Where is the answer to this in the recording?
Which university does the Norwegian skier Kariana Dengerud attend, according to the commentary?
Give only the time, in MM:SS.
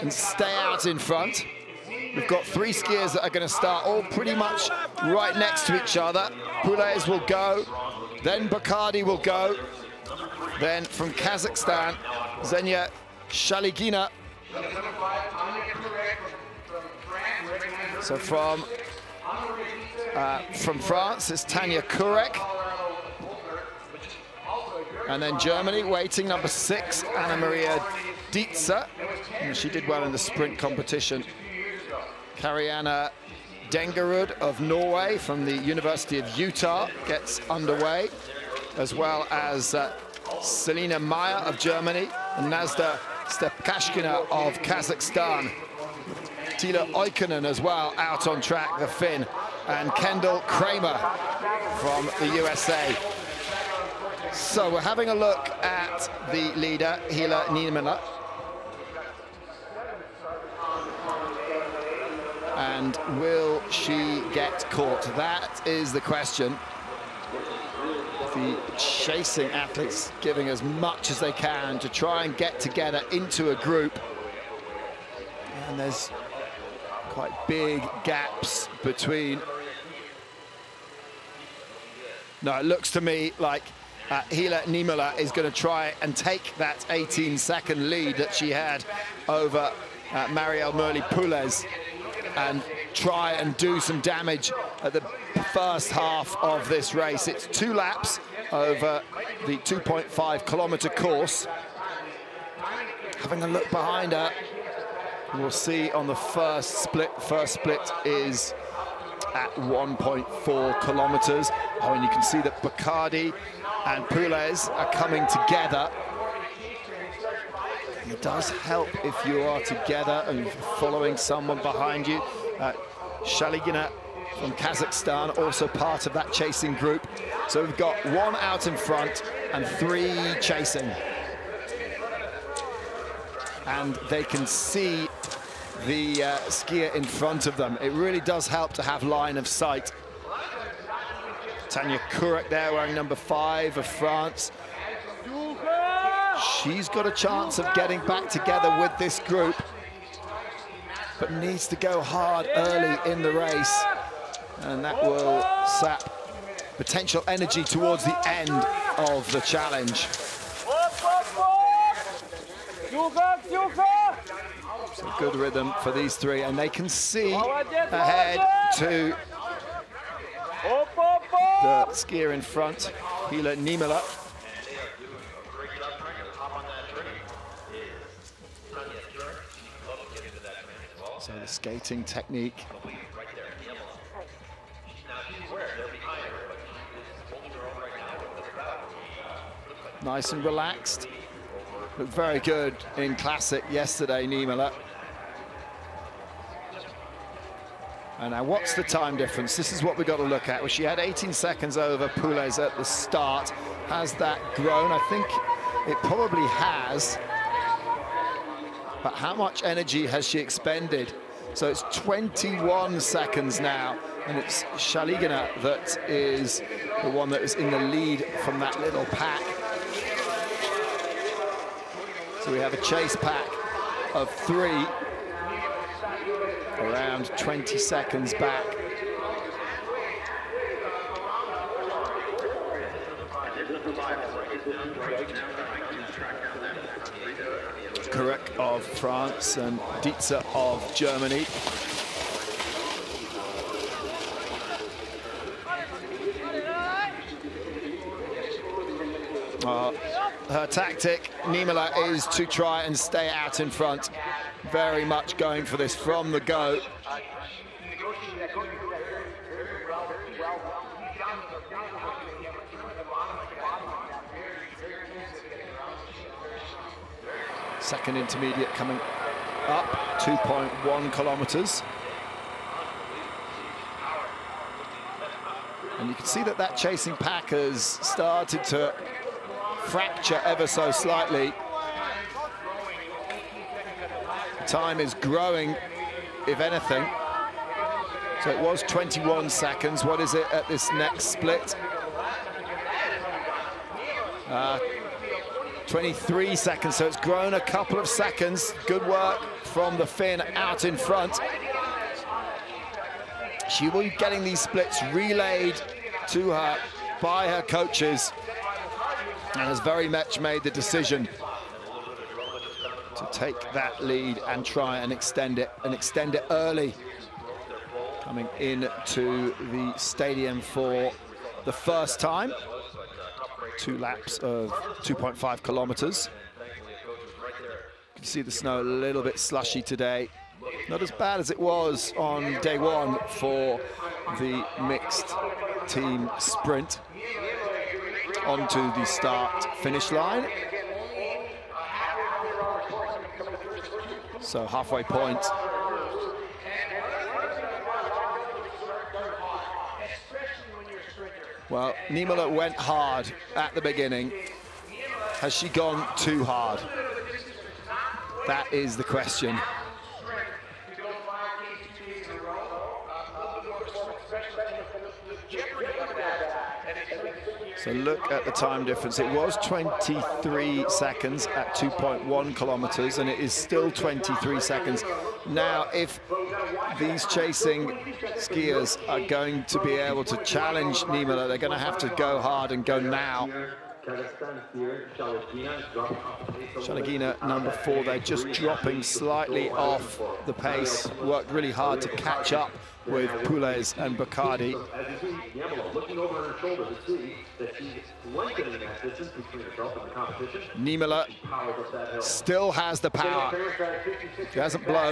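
00:35.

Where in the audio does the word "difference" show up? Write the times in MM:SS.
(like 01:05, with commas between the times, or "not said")
03:19, 06:08.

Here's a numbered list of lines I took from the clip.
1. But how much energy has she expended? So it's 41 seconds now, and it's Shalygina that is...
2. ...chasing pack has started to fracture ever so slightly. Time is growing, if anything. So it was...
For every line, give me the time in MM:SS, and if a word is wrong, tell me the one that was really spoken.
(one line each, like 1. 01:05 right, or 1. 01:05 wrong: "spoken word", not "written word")
1. 03:29 wrong: "21", not "41"
2. 04:36 right.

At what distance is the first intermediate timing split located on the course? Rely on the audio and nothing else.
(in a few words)
1.4 kilometers.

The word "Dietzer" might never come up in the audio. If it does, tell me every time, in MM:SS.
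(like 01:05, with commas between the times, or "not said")
00:28, 04:00.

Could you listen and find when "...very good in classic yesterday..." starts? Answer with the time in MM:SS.
03:12.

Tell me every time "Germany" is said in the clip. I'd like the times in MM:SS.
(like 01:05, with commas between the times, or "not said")
00:25, 00:41, 04:00.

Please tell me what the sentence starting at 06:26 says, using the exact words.
Shalygina, number four, they're just dropping slightly off the pace.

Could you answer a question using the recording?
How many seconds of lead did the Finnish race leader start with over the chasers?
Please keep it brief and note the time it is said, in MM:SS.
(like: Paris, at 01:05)
18, at 01:26.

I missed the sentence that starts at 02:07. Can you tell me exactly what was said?
So we've got one out in front and three chasing.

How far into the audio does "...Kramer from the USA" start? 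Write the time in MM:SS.
00:50.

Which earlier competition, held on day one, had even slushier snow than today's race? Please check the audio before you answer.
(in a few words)
mixed team sprint.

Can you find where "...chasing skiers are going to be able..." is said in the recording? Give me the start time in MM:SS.
06:17.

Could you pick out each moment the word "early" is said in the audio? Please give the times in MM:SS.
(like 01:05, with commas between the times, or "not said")
02:32, 05:16.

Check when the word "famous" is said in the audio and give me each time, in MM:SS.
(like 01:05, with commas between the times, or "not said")
not said.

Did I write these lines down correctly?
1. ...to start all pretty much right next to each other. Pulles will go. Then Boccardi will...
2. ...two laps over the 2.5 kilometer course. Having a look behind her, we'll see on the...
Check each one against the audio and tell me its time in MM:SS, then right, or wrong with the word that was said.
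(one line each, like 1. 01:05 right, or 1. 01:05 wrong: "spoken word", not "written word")
1. 00:03 right
2. 01:37 right.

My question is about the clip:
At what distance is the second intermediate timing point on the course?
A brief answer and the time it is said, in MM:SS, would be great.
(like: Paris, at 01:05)
2.1 kilometres, at 04:30.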